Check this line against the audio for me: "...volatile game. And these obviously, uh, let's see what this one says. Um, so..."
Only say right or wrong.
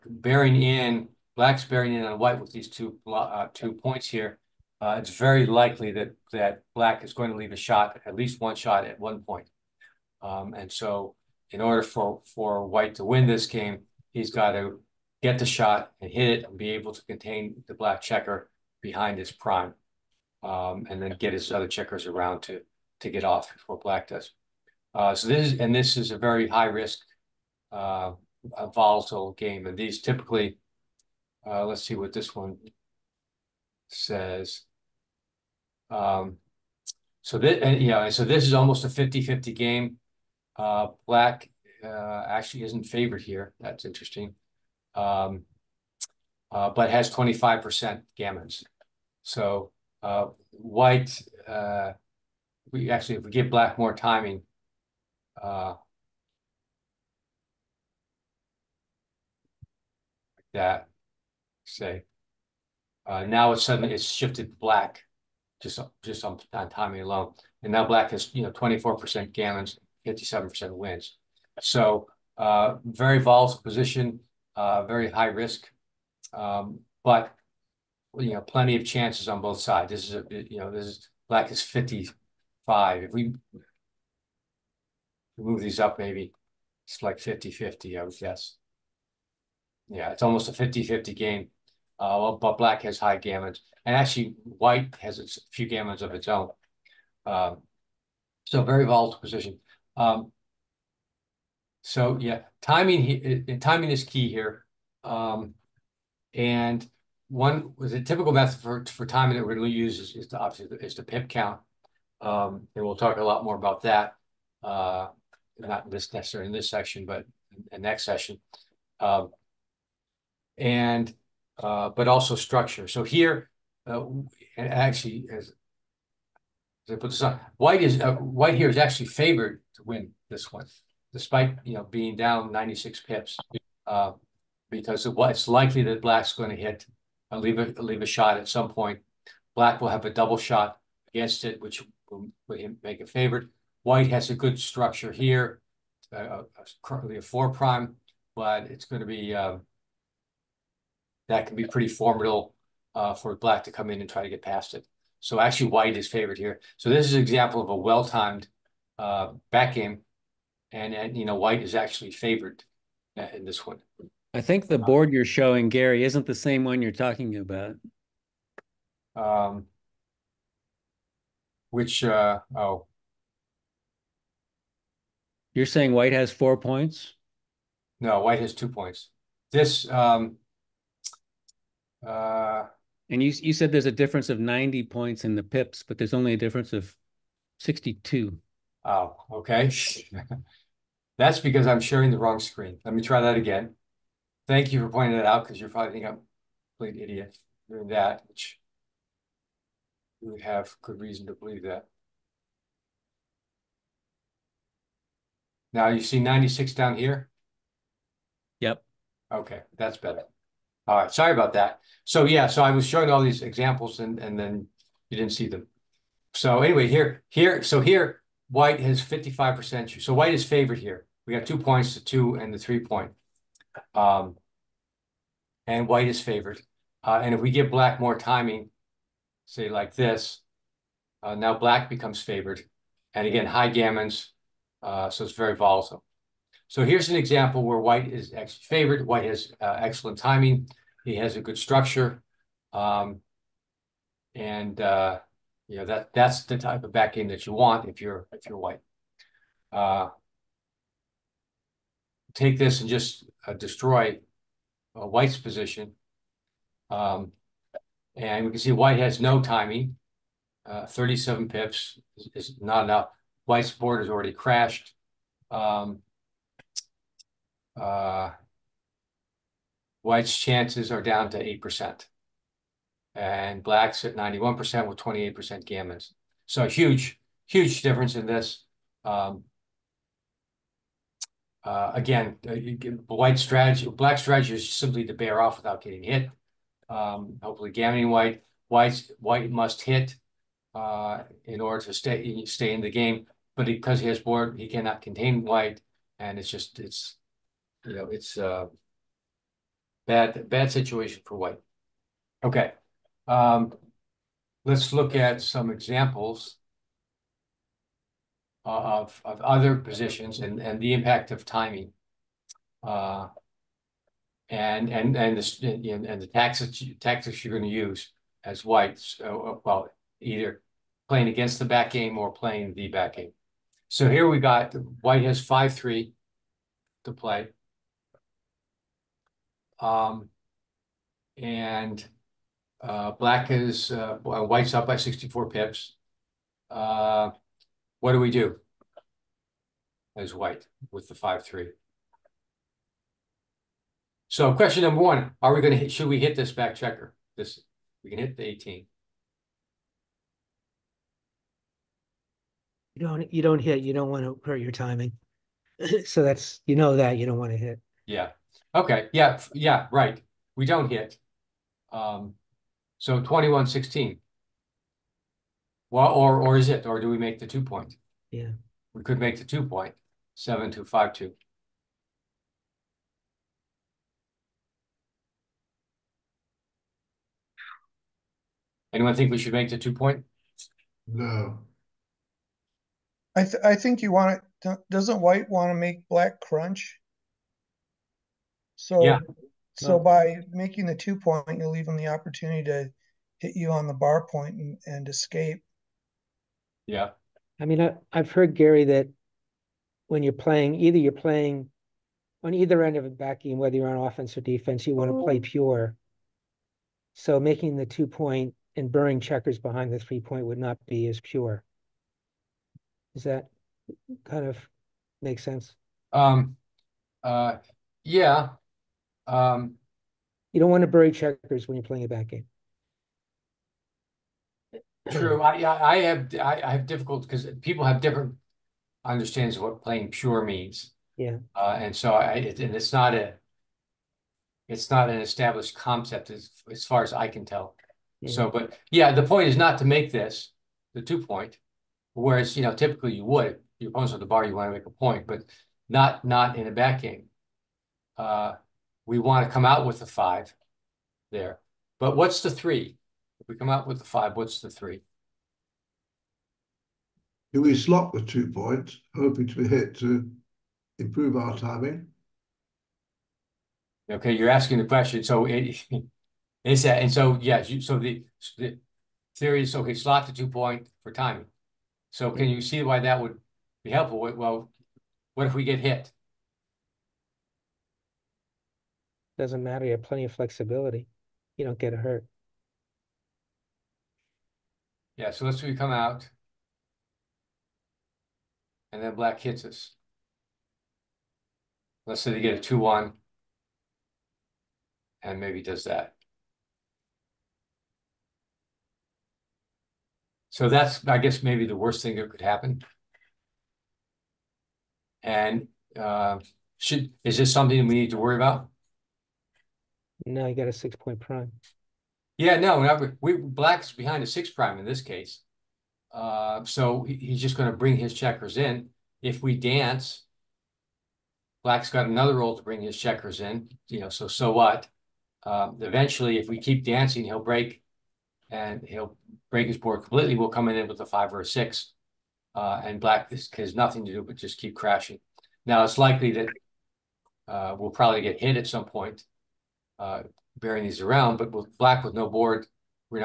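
wrong.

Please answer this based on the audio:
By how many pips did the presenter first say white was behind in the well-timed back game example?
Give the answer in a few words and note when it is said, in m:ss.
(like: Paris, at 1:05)
96, at 2:12.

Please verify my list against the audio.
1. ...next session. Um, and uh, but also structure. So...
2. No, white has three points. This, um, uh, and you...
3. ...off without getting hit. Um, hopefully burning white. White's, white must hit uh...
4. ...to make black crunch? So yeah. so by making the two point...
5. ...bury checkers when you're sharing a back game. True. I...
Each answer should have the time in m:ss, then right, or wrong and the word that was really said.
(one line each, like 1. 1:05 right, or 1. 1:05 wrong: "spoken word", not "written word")
1. 1:57 right
2. 2:58 wrong: "two", not "three"
3. 4:45 wrong: "gammoning", not "burning"
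4. 6:25 right
5. 7:00 wrong: "playing", not "sharing".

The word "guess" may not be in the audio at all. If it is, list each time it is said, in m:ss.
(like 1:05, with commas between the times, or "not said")
1:28, 8:21.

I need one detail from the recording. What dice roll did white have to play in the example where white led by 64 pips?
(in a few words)
5-3.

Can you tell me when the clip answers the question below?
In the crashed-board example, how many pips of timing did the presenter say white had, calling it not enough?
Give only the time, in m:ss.
4:20.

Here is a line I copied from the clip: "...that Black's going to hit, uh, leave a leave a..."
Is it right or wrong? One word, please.
right.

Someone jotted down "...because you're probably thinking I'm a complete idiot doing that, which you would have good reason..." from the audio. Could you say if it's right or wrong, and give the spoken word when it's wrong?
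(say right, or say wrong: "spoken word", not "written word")
right.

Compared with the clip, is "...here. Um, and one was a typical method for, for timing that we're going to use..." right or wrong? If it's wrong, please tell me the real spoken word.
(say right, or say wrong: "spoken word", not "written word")
right.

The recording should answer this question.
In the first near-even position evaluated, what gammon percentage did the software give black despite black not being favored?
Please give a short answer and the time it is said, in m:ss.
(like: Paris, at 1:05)
25%, at 0:47.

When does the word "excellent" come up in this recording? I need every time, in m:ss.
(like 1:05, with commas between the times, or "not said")
3:59.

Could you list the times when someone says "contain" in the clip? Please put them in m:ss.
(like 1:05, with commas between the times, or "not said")
0:17, 4:55.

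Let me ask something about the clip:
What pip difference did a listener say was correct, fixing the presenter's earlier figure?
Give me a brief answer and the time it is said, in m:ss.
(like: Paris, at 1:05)
62, at 3:07.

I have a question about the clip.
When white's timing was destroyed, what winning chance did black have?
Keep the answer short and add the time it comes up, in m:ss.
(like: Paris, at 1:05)
91%, at 4:34.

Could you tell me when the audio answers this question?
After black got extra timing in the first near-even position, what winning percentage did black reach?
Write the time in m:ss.
1:10.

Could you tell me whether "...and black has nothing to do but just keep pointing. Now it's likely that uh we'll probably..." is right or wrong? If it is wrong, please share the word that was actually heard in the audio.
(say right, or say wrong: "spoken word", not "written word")
wrong: "crashing", not "pointing".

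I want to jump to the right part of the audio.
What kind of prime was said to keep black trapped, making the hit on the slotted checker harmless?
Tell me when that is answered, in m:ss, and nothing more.
8:30.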